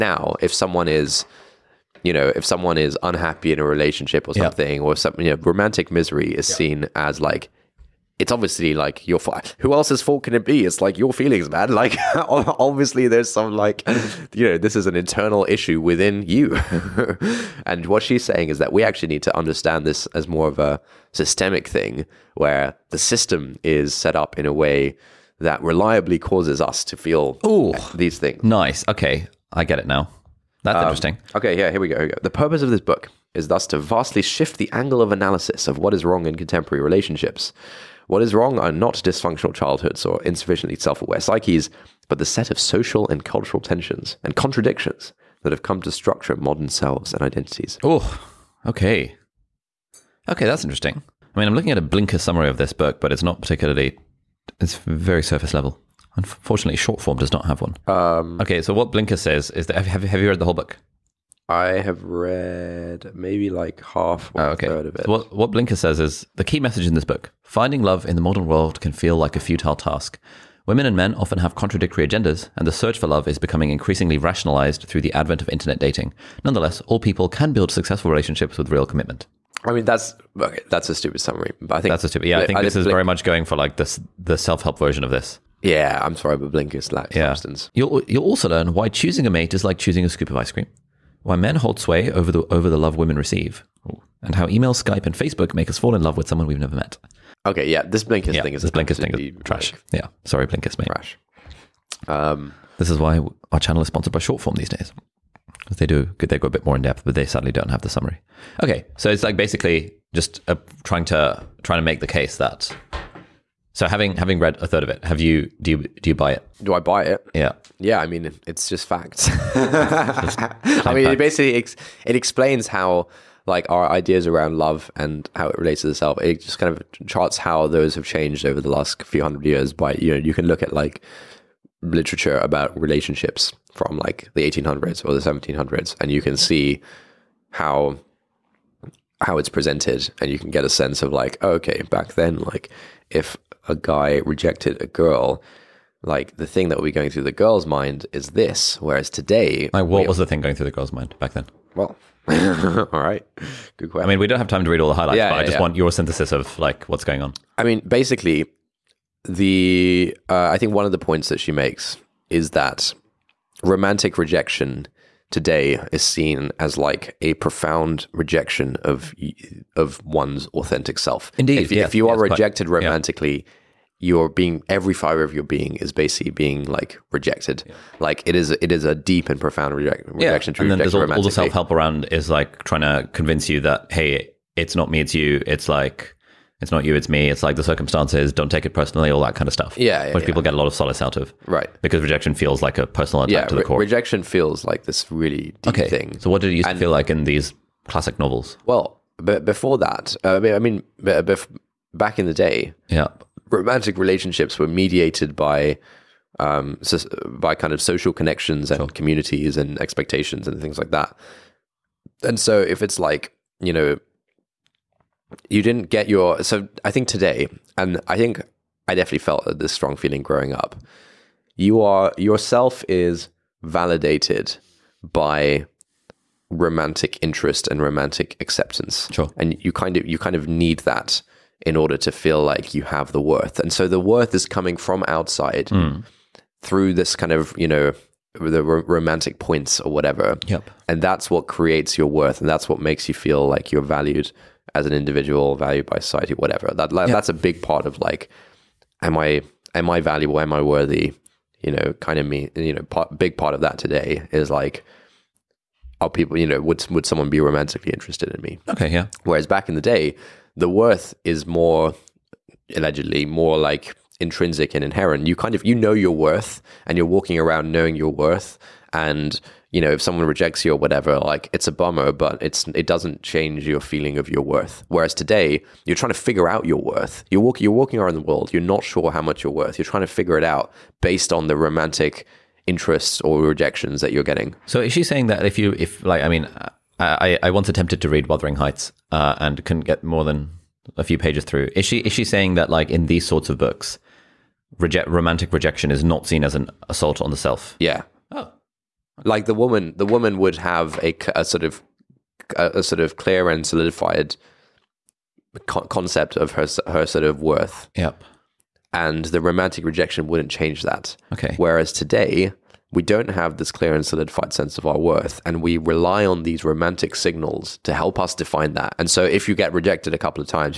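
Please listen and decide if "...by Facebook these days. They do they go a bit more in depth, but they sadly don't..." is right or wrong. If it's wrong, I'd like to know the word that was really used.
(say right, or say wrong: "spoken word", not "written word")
wrong: "Shortform", not "Facebook".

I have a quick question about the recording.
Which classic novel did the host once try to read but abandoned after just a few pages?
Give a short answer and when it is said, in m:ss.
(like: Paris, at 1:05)
Wuthering Heights, at 4:48.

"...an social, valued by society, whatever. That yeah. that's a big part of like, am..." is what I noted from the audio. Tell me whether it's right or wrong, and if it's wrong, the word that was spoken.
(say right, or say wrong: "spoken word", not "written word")
wrong: "individual", not "social".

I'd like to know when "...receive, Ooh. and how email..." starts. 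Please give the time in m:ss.
1:33.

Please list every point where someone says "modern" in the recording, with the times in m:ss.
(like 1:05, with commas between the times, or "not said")
0:46, 1:08.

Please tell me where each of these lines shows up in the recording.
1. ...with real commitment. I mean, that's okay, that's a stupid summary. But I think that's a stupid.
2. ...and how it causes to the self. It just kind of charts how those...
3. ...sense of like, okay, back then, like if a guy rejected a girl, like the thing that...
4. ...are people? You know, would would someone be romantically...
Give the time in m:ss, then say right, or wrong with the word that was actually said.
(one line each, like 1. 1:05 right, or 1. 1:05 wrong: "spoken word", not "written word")
1. 1:18 right
2. 2:04 wrong: "relates", not "causes"
3. 2:20 right
4. 4:16 right.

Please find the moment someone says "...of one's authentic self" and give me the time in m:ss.
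2:49.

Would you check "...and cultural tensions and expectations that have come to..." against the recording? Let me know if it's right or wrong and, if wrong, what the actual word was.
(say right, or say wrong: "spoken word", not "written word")
wrong: "contradictions", not "expectations".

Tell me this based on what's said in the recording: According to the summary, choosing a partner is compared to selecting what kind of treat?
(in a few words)
a scoop of ice cream.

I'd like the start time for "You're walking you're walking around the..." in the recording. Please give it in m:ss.
4:37.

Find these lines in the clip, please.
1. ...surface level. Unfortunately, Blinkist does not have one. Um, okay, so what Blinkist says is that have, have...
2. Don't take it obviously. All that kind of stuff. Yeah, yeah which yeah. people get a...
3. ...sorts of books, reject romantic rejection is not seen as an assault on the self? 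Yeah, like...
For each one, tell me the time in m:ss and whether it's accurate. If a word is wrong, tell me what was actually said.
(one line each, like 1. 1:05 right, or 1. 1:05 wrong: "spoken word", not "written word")
1. 0:55 wrong: "Shortform", not "Blinkist"
2. 3:08 wrong: "personally", not "obviously"
3. 4:53 right.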